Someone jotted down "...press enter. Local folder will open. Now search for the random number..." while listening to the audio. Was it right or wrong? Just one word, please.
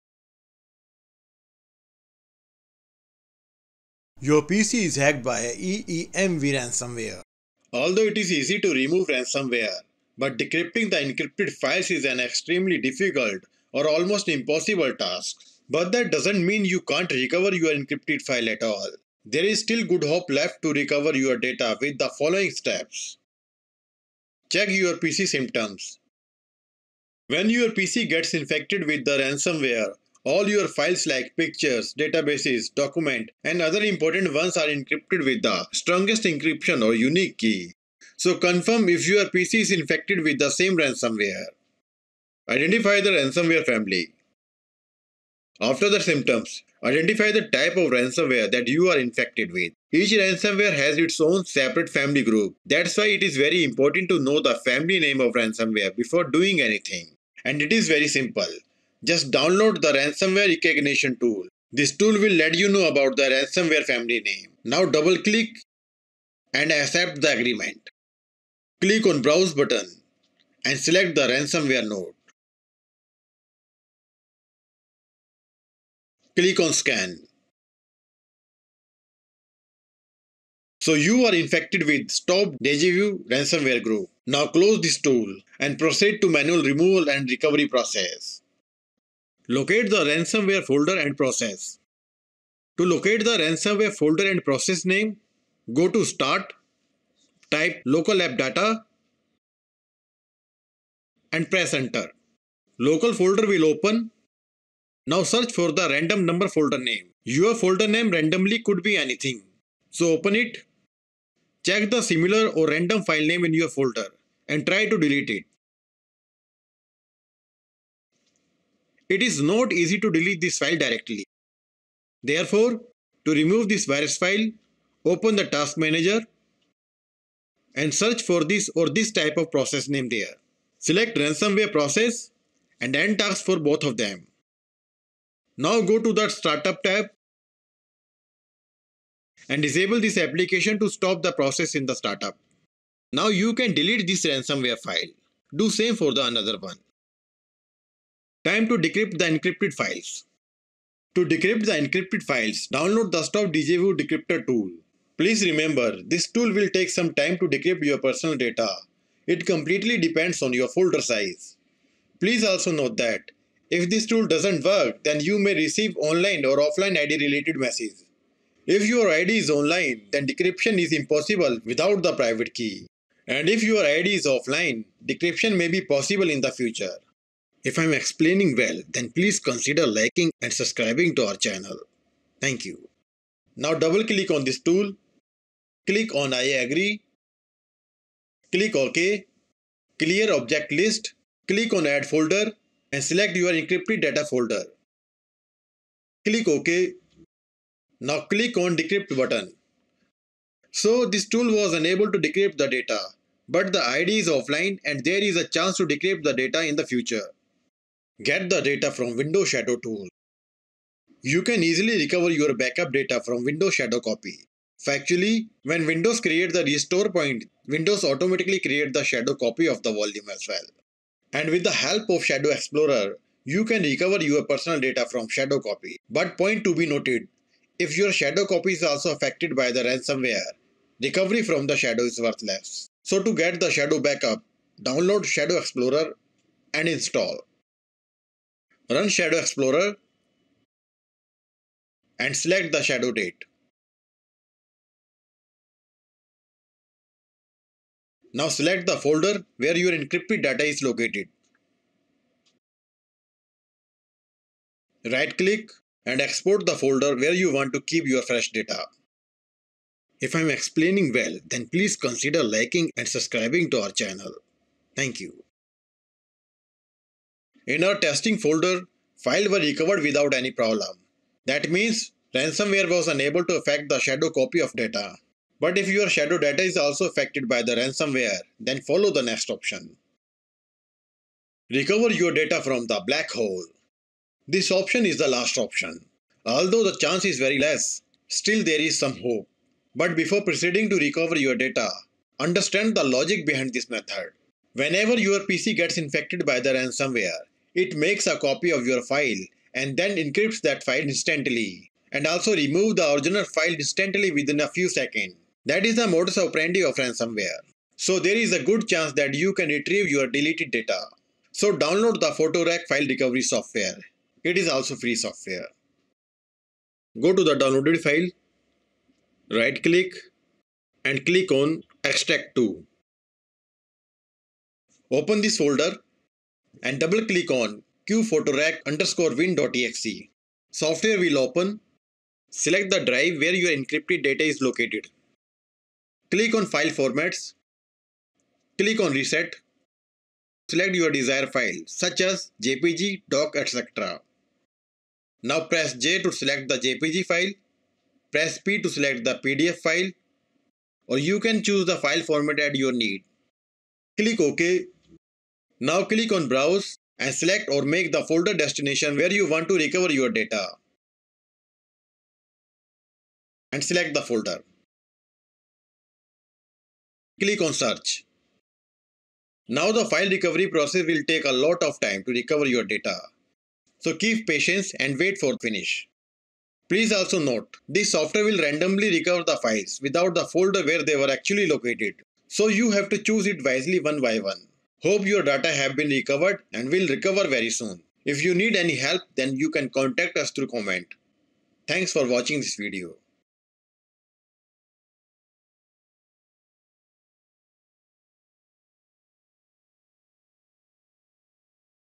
right.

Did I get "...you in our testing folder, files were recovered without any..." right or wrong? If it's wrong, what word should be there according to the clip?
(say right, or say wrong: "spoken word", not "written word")
right.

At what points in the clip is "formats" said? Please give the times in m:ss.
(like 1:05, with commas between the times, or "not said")
5:36, 5:52.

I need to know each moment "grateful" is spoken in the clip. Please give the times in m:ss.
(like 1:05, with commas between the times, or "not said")
not said.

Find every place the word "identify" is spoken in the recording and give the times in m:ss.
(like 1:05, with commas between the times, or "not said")
0:42, 0:46.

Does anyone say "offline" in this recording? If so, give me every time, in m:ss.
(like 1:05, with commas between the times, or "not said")
2:46, 2:54, 3:24.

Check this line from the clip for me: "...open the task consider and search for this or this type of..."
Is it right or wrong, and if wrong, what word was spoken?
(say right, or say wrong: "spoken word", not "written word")
wrong: "manager", not "consider".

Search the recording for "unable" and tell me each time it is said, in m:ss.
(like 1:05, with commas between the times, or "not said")
3:21, 4:33.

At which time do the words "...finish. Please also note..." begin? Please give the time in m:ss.
6:15.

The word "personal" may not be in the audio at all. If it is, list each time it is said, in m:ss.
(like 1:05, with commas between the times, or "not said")
2:37, 3:44.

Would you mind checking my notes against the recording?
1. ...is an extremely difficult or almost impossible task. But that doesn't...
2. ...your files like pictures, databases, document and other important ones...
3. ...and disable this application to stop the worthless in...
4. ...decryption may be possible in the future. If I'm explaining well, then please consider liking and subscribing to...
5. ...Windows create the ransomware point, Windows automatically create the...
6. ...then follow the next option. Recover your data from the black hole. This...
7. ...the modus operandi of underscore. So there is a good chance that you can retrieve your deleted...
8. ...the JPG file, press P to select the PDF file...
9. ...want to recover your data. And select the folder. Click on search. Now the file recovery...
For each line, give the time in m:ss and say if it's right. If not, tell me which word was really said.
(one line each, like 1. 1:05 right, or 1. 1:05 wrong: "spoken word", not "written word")
1. 0:11 right
2. 0:30 right
3. 2:19 wrong: "process", not "worthless"
4. 2:55 right
5. 3:35 wrong: "restore", not "ransomware"
6. 4:38 right
7. 5:05 wrong: "ransomware", not "underscore"
8. 5:46 right
9. 5:59 right.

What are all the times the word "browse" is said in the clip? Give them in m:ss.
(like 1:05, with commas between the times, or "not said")
1:09, 5:56.